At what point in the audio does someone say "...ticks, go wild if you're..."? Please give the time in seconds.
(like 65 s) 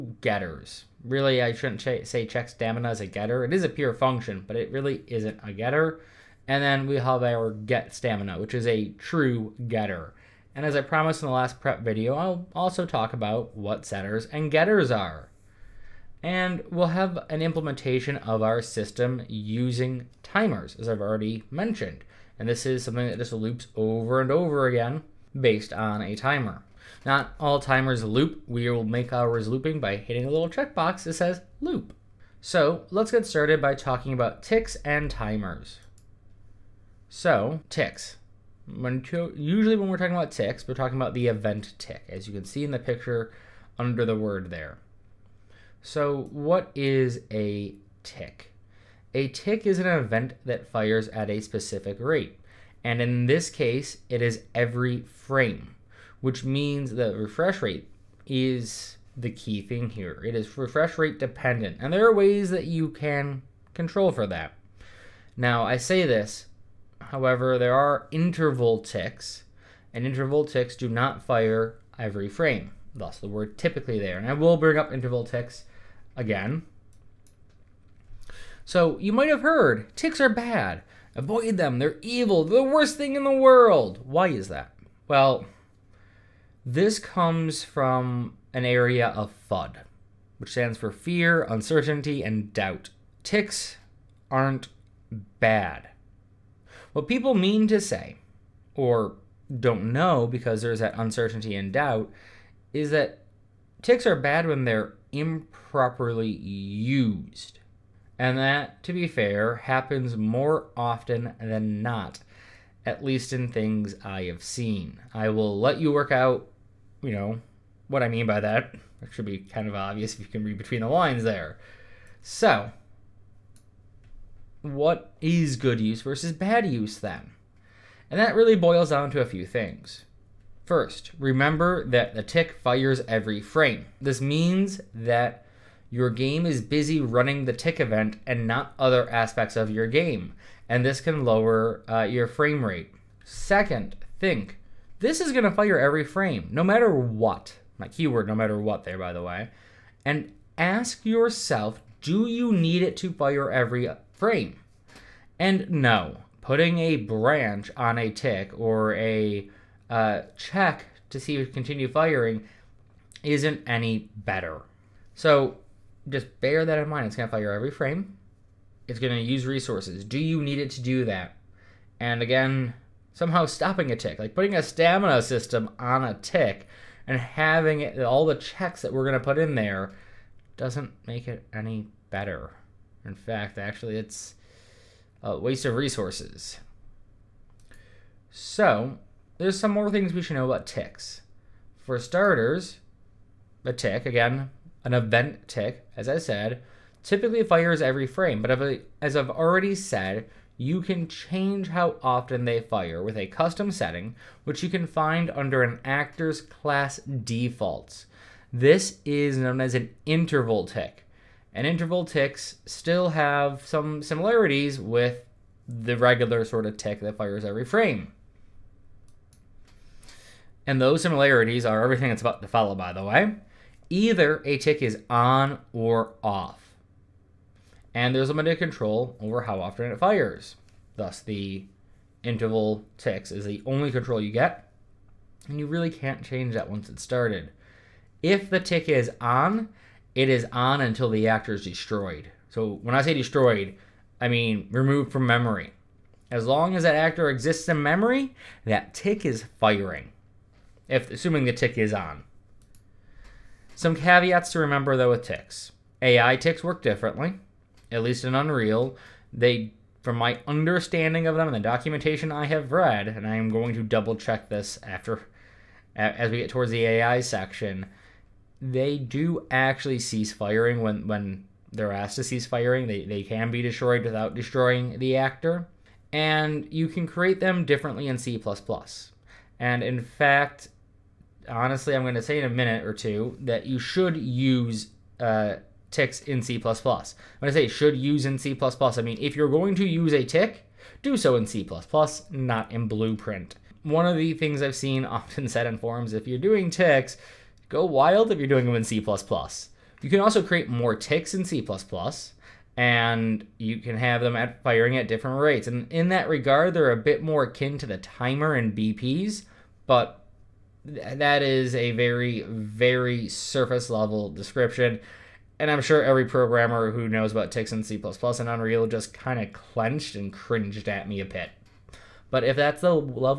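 296 s.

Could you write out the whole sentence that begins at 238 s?
If the tick is on, it is on until the actor is destroyed.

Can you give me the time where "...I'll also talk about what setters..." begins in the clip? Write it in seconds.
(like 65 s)
12 s.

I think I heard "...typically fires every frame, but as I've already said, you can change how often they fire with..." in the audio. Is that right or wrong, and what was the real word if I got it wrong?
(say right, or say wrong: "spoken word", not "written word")
right.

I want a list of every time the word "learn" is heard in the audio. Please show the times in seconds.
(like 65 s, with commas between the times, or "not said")
not said.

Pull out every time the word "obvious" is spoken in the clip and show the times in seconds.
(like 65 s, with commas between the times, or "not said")
119 s.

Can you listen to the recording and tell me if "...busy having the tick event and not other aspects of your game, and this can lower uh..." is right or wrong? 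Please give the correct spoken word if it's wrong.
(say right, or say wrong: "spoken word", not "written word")
wrong: "running", not "having".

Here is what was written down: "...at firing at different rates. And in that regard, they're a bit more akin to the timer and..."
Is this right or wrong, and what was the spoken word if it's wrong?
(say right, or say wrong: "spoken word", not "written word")
right.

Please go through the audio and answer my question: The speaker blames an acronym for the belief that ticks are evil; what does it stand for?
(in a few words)
fear, uncertainty, and doubt.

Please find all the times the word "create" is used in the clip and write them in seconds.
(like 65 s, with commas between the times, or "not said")
277 s, 300 s.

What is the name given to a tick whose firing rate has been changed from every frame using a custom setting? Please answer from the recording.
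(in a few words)
interval tick.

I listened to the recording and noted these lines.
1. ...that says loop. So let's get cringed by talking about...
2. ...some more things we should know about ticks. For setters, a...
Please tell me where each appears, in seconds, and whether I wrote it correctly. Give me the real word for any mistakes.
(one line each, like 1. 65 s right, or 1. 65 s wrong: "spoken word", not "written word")
1. 31 s wrong: "started", not "cringed"
2. 189 s wrong: "starters", not "setters".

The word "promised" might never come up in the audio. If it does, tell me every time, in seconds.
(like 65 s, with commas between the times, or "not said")
10 s.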